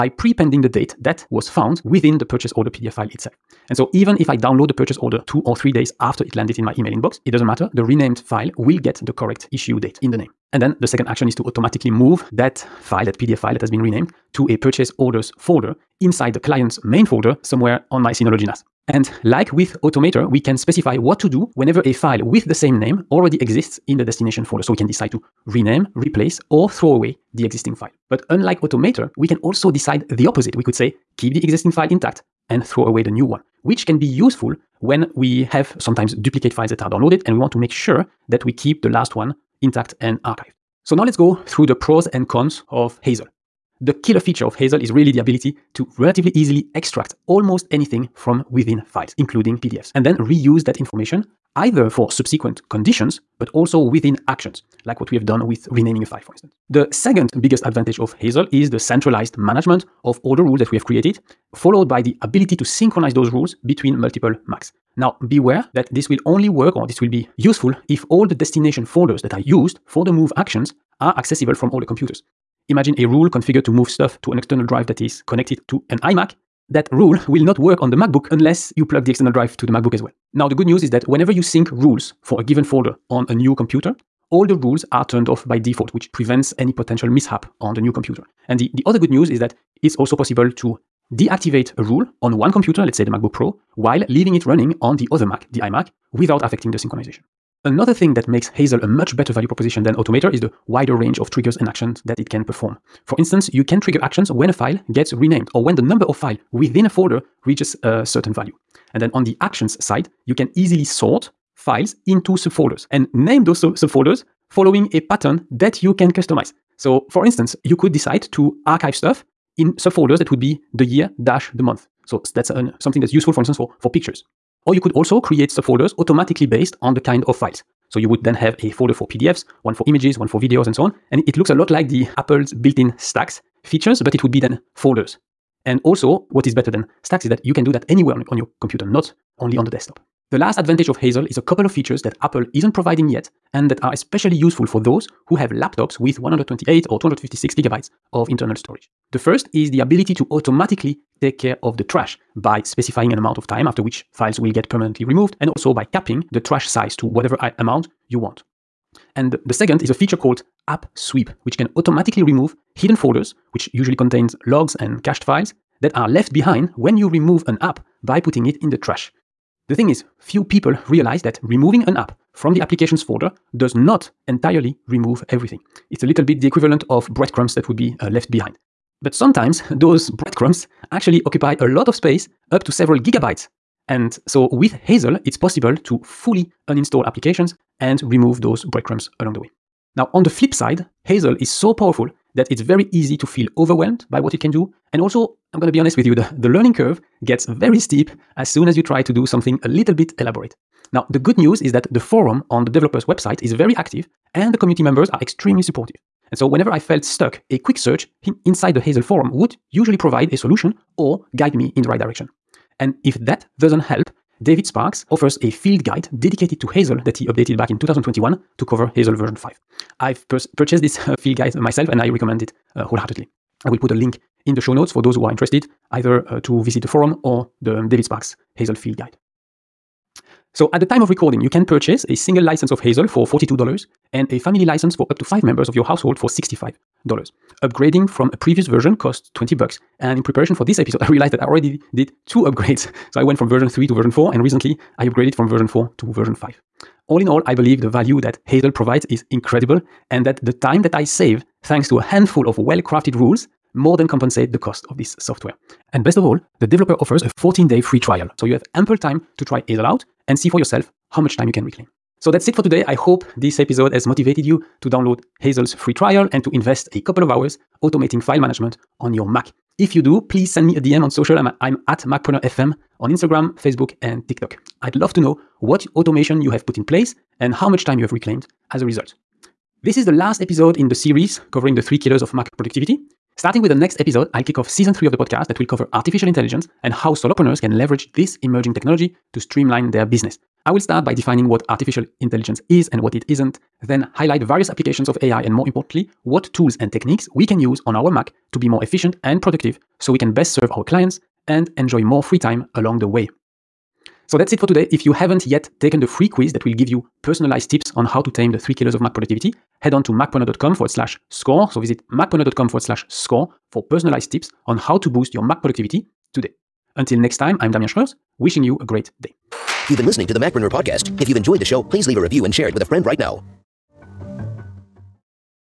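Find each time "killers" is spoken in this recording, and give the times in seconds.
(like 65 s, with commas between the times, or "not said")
44 s, 281 s, 308 s.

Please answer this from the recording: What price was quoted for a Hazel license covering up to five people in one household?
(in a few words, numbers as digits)
$65.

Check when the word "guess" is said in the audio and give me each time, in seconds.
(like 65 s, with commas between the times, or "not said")
not said.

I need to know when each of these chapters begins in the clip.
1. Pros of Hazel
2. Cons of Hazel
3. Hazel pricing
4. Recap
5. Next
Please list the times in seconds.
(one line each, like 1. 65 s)
1. 40 s
2. 189 s
3. 230 s
4. 261 s
5. 279 s.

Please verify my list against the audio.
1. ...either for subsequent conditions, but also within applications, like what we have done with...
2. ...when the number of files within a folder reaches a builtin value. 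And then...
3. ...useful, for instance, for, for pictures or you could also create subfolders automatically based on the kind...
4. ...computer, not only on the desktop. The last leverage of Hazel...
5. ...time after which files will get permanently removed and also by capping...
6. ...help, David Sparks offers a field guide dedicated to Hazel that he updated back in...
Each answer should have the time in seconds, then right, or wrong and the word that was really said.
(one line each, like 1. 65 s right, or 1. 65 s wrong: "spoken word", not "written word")
1. 51 s wrong: "actions", not "applications"
2. 105 s wrong: "certain", not "builtin"
3. 123 s right
4. 138 s wrong: "advantage", not "leverage"
5. 153 s right
6. 213 s right.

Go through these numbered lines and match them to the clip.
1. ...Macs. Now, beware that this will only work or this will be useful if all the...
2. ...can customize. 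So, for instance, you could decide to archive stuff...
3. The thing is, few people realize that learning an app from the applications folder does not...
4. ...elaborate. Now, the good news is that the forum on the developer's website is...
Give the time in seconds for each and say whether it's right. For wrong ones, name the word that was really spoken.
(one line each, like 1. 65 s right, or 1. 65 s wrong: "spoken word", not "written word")
1. 64 s right
2. 115 s right
3. 169 s wrong: "removing", not "learning"
4. 200 s right.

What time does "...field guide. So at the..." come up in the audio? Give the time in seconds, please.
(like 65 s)
228 s.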